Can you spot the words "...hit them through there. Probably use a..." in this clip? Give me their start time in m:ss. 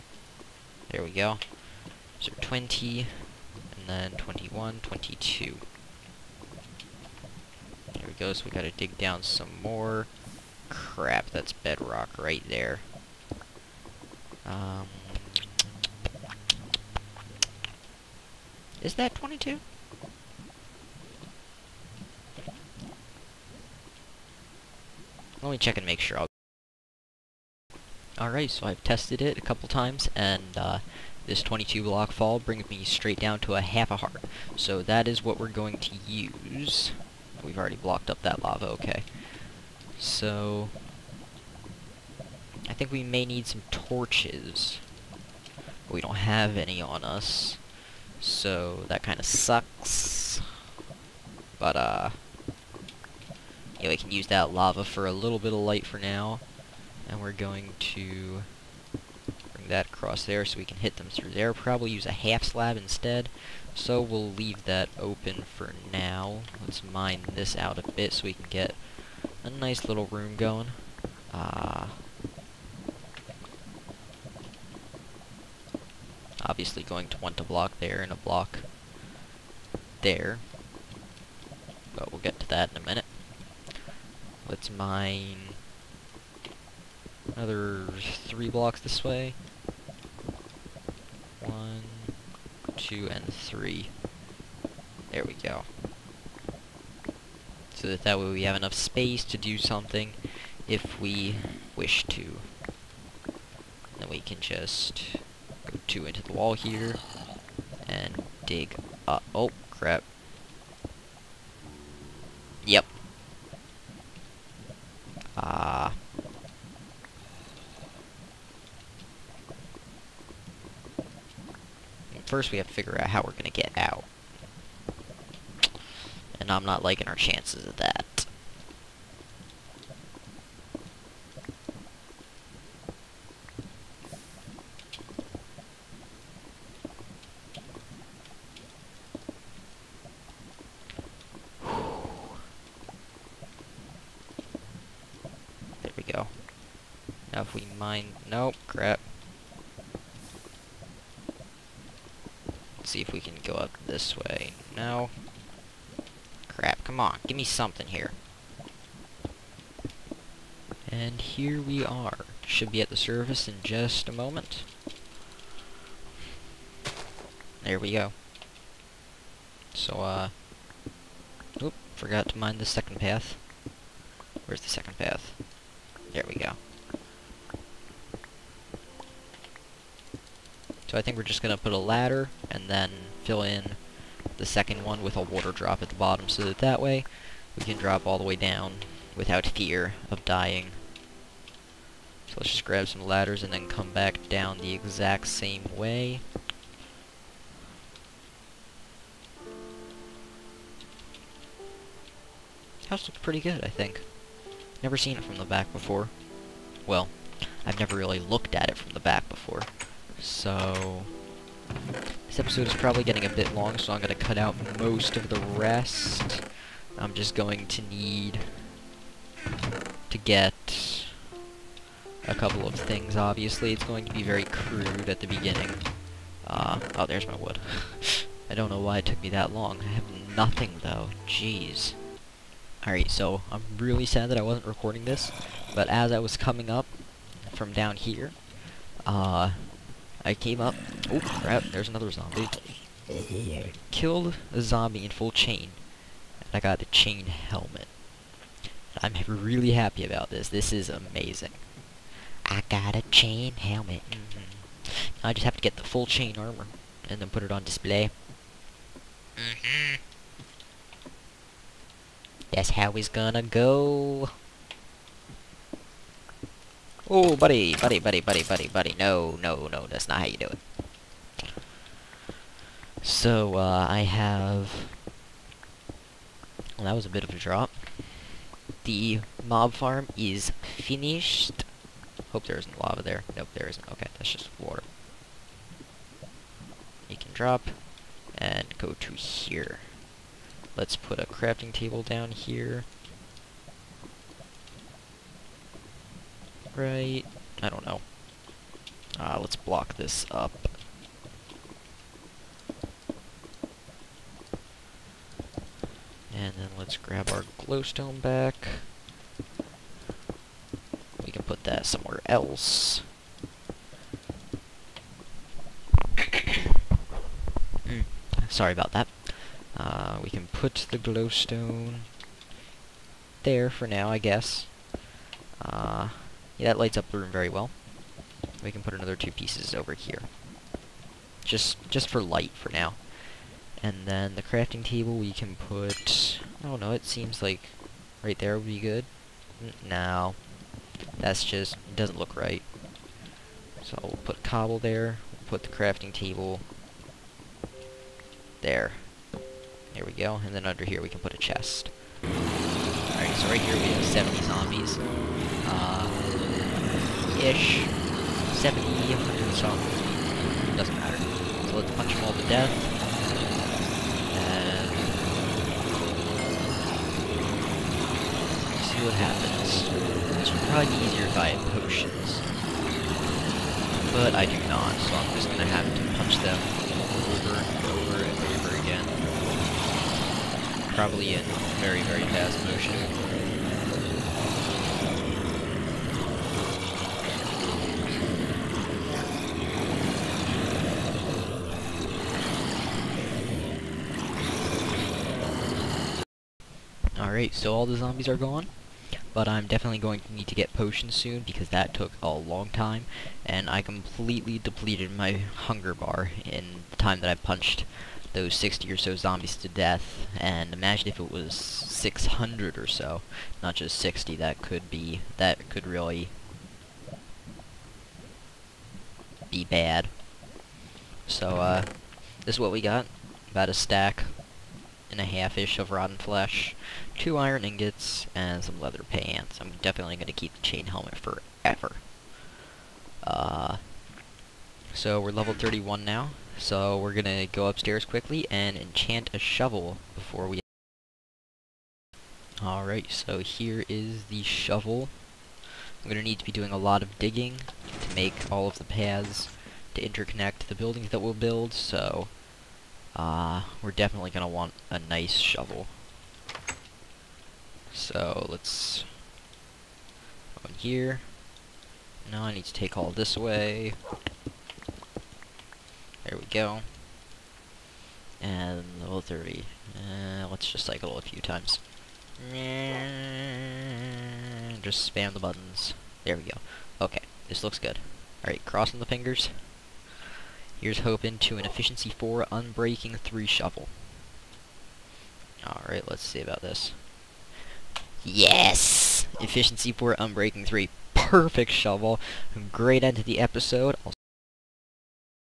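1:00.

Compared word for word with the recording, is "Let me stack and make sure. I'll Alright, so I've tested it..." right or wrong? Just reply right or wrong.
wrong.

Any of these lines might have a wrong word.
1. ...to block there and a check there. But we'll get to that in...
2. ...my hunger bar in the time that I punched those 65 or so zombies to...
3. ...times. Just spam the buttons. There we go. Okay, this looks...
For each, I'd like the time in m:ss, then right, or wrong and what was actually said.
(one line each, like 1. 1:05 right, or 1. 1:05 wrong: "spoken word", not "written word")
1. 1:17 wrong: "block", not "check"
2. 6:45 wrong: "60", not "65"
3. 7:51 right.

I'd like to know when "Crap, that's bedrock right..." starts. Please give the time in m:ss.
0:10.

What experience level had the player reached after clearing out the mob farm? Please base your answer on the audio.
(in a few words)
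31.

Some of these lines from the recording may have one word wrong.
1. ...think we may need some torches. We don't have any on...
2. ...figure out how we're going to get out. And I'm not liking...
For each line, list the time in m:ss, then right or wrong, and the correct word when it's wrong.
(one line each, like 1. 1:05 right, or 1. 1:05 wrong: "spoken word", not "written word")
1. 0:42 right
2. 2:02 right.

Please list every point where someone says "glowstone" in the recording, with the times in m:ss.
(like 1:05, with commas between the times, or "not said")
5:07, 5:20.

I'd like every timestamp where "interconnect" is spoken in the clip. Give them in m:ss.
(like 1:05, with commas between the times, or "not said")
7:30.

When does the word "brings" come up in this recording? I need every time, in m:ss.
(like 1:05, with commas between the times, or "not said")
0:32, 0:59.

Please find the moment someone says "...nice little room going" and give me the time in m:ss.
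1:09.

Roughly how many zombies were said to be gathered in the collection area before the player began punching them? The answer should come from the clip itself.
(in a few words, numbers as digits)
70.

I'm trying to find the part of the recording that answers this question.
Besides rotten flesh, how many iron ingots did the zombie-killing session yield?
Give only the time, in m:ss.
7:07.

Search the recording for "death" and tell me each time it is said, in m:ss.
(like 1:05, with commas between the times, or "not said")
6:02, 6:49.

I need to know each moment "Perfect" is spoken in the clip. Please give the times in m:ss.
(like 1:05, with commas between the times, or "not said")
8:11.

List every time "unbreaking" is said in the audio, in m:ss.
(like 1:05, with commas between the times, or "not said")
8:02, 8:10.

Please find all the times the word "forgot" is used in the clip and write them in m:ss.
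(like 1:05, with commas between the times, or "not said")
2:51.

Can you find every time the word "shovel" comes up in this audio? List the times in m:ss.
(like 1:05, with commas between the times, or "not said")
7:19, 7:24, 7:35, 8:03, 8:11.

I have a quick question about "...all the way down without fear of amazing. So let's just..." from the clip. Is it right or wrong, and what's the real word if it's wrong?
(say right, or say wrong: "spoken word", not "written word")
wrong: "dying", not "amazing".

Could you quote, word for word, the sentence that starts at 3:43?
It's going to be very crude at the beginning.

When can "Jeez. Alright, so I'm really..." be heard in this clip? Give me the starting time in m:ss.
3:51.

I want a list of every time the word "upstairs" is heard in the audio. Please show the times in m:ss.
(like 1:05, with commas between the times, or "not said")
7:17.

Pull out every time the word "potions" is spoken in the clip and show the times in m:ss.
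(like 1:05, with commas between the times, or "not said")
6:11, 6:40.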